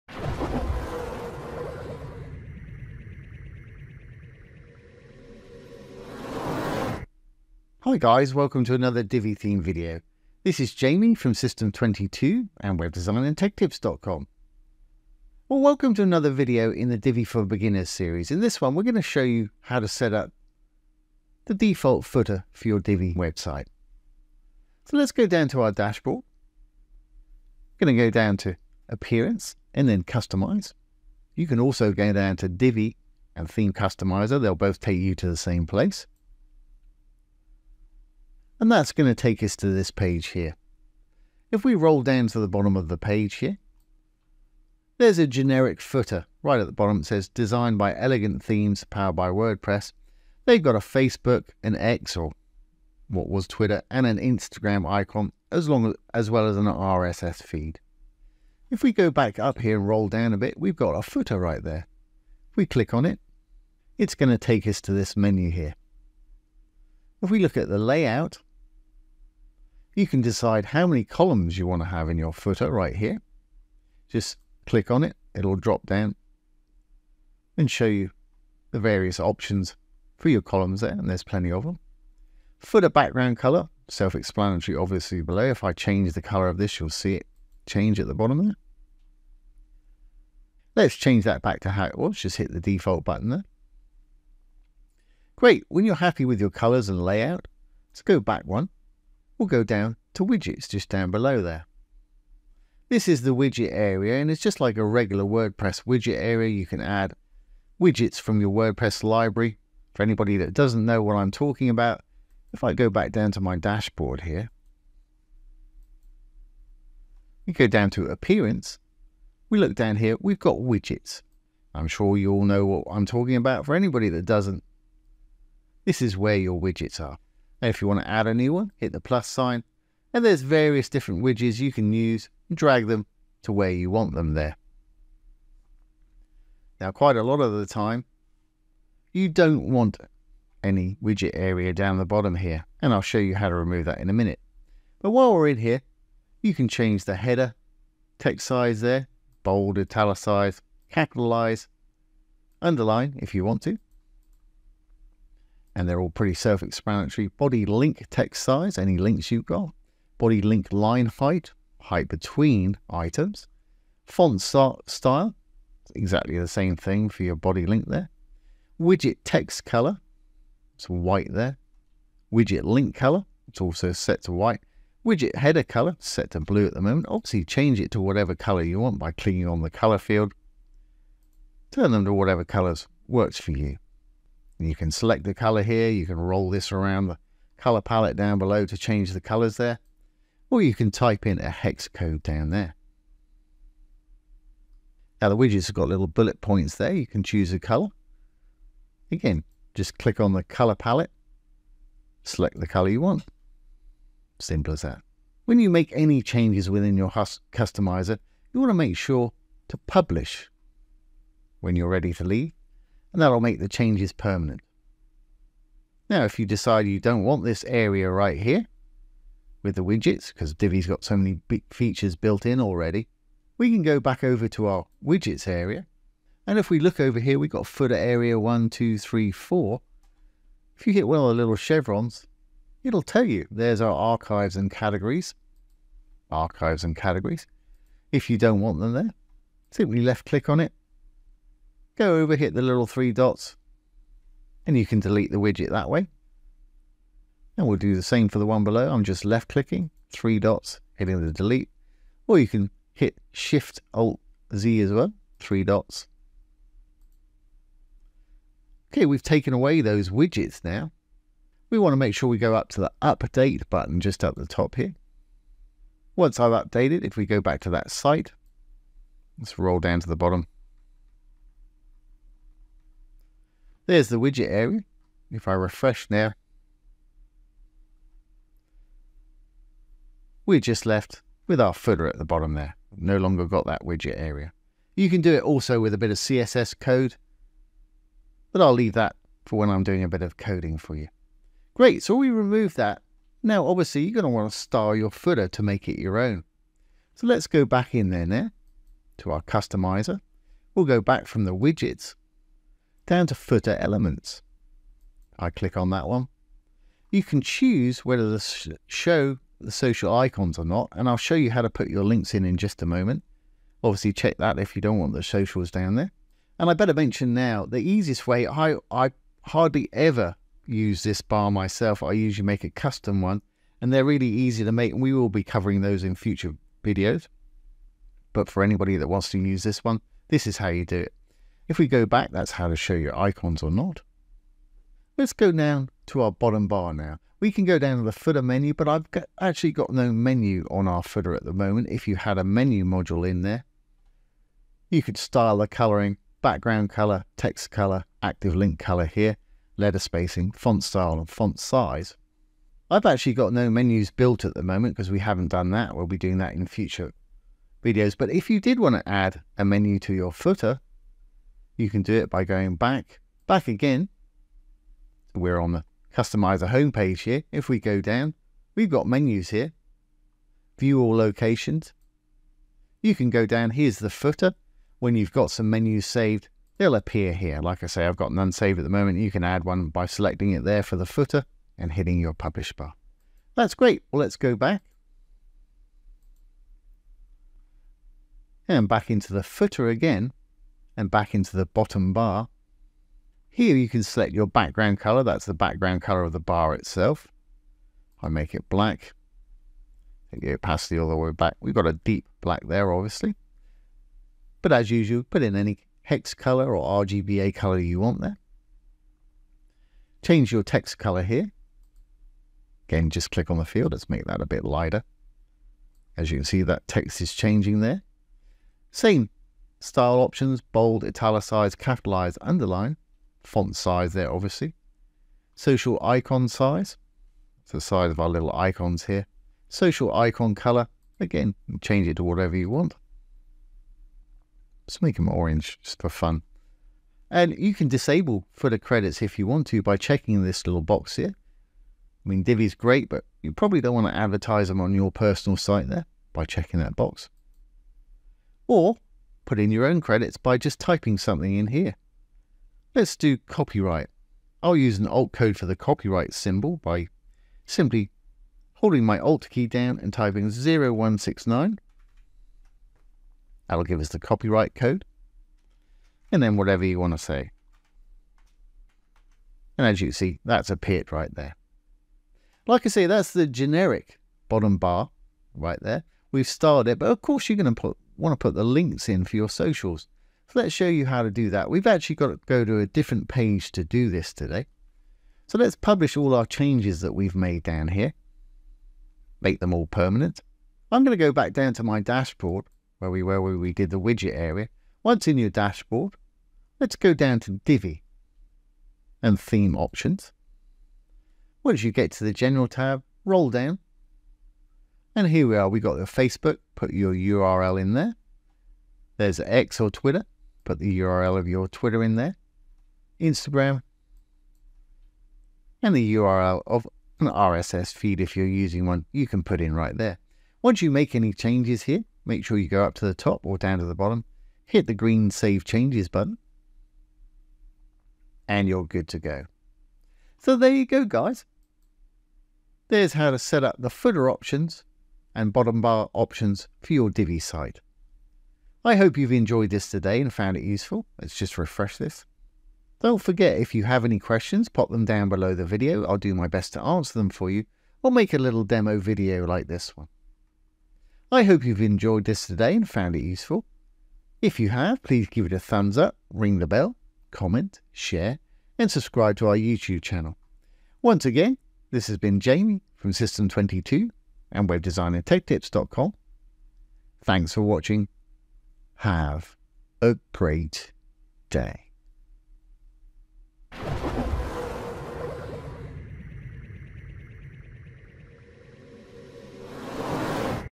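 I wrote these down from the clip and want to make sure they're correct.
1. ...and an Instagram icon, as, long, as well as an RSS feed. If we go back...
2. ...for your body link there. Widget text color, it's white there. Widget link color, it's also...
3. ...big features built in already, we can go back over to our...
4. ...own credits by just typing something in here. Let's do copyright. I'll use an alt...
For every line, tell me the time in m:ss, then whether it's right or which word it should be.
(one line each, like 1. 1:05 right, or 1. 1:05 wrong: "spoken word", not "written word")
1. 0:53 right
2. 2:47 right
3. 3:41 right
4. 7:29 right.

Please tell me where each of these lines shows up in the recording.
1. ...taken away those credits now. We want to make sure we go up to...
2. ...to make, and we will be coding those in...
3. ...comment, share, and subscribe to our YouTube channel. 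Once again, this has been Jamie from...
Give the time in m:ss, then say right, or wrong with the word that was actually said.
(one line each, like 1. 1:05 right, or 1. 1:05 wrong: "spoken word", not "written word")
1. 4:19 wrong: "widgets", not "credits"
2. 5:24 wrong: "covering", not "coding"
3. 9:17 right.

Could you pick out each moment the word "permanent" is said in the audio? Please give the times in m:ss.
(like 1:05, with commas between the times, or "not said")
3:34, 8:09.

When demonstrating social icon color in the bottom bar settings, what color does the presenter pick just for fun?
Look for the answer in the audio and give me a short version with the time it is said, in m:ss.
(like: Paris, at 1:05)
Orange, at 7:15.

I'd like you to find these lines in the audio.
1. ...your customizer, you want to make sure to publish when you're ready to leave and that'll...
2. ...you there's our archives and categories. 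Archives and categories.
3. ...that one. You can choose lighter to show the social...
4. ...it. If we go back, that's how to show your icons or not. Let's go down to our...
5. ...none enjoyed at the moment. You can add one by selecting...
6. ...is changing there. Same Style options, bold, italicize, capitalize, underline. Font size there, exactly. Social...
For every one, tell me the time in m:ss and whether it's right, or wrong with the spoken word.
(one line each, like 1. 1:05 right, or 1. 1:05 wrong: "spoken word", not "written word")
1. 3:26 right
2. 3:53 right
3. 5:05 wrong: "whether", not "lighter"
4. 5:30 right
5. 6:18 wrong: "saved", not "enjoyed"
6. 6:57 wrong: "obviously", not "exactly".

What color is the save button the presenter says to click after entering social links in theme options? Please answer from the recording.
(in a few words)
Green.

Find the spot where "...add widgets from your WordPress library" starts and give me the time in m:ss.
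1:46.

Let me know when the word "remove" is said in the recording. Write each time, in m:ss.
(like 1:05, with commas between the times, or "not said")
2:23, 4:52.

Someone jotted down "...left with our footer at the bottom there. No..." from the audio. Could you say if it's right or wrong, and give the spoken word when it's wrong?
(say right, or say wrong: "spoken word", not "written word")
right.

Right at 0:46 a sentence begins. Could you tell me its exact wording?
It says designed by Elegant Themes, powered by WordPress.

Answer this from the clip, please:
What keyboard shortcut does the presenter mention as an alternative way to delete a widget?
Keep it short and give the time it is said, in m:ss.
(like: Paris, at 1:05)
Shift Alt Z, at 4:13.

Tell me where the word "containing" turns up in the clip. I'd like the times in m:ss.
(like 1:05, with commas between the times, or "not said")
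not said.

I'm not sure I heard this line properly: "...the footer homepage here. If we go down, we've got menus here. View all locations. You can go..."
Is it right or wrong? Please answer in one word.
wrong.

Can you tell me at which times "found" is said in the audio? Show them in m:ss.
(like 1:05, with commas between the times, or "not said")
9:00, 9:12.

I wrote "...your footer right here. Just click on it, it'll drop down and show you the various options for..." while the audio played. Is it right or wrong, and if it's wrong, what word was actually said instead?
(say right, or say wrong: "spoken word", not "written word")
right.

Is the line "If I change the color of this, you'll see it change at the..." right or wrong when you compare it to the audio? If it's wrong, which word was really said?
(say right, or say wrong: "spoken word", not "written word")
right.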